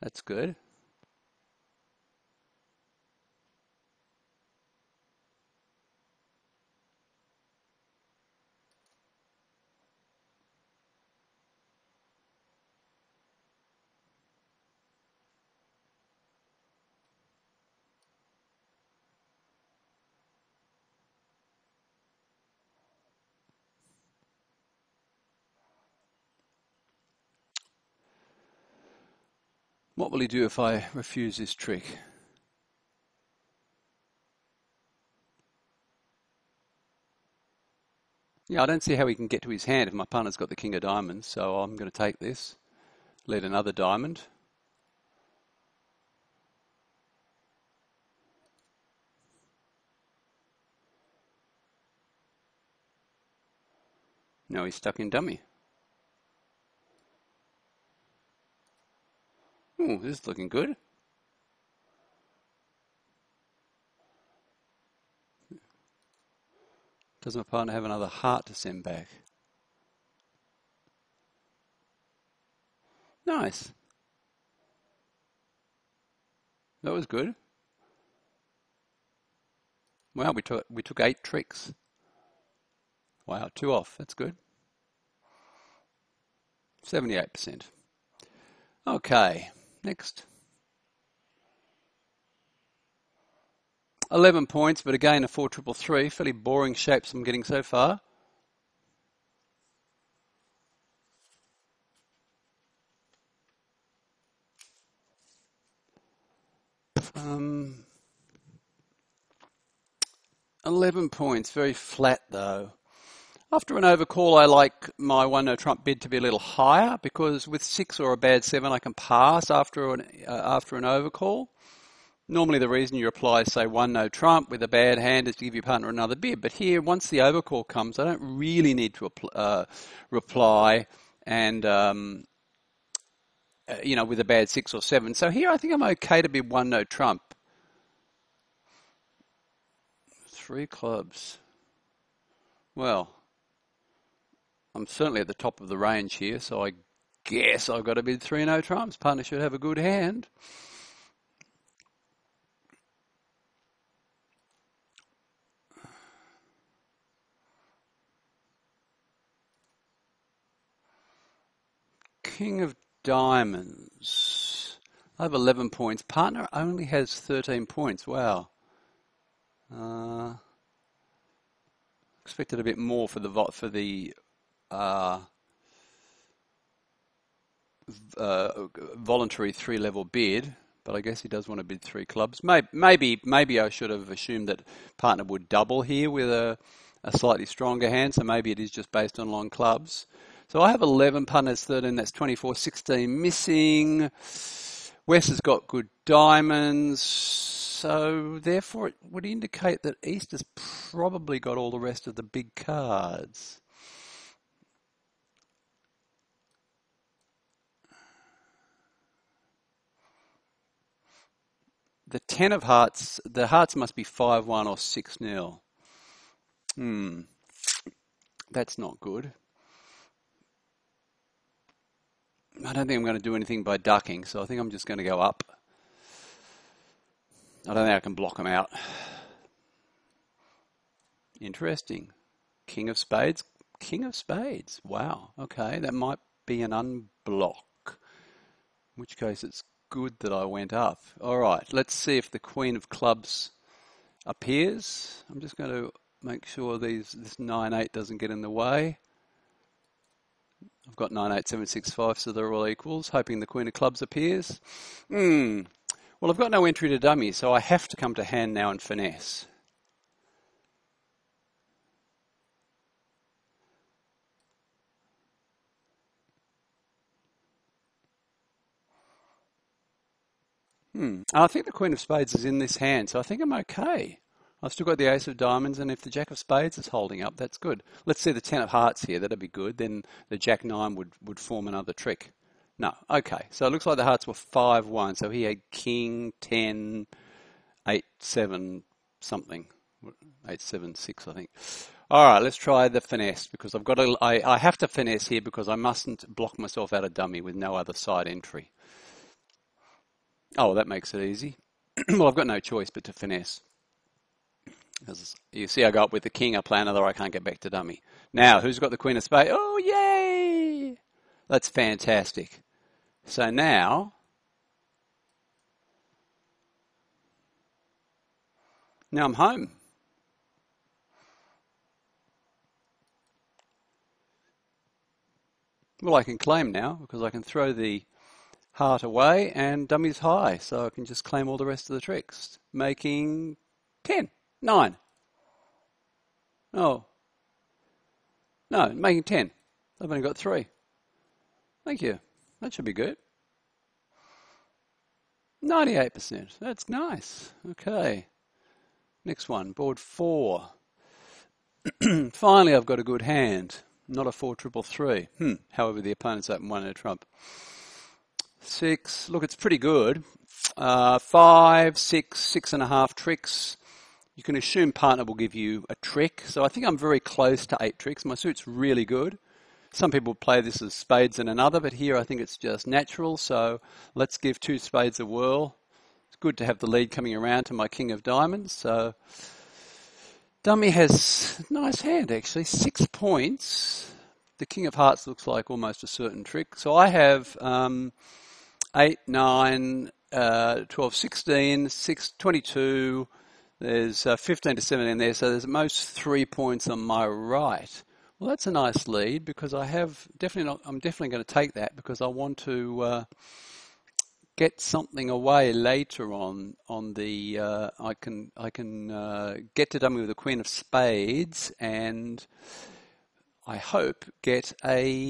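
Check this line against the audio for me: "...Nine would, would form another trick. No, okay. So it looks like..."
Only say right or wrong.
right.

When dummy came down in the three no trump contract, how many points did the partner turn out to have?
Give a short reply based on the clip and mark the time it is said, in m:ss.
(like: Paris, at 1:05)
13, at 2:47.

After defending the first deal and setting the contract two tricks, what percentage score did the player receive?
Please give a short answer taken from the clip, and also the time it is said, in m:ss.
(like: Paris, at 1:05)
78%, at 1:26.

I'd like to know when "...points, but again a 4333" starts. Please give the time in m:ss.
1:34.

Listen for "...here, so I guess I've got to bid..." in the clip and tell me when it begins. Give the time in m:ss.
2:26.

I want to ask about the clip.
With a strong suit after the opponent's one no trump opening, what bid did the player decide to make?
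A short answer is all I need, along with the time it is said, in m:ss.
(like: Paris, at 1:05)
Two spades, at 6:14.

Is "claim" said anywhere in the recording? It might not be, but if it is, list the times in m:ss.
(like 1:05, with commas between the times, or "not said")
5:26, 5:31.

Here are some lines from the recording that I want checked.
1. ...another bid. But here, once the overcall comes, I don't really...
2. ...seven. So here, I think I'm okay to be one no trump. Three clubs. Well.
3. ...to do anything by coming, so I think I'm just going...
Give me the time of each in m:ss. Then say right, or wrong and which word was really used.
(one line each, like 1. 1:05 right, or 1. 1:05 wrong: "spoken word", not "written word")
1. 2:05 right
2. 2:14 right
3. 3:43 wrong: "ducking", not "coming".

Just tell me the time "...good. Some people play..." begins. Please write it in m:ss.
6:09.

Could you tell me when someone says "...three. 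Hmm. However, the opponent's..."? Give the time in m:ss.
5:54.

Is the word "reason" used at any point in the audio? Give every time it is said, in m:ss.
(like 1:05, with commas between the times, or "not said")
2:02.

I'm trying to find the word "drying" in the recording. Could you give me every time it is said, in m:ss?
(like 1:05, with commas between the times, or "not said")
not said.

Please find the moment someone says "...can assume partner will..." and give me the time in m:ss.
6:04.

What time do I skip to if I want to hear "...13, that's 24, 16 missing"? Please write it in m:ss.
3:11.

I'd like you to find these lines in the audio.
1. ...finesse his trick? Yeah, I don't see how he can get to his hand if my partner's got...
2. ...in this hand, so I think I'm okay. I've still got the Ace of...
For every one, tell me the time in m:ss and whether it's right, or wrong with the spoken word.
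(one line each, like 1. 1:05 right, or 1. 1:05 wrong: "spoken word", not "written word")
1. 0:30 wrong: "refuse", not "finesse"
2. 4:32 right.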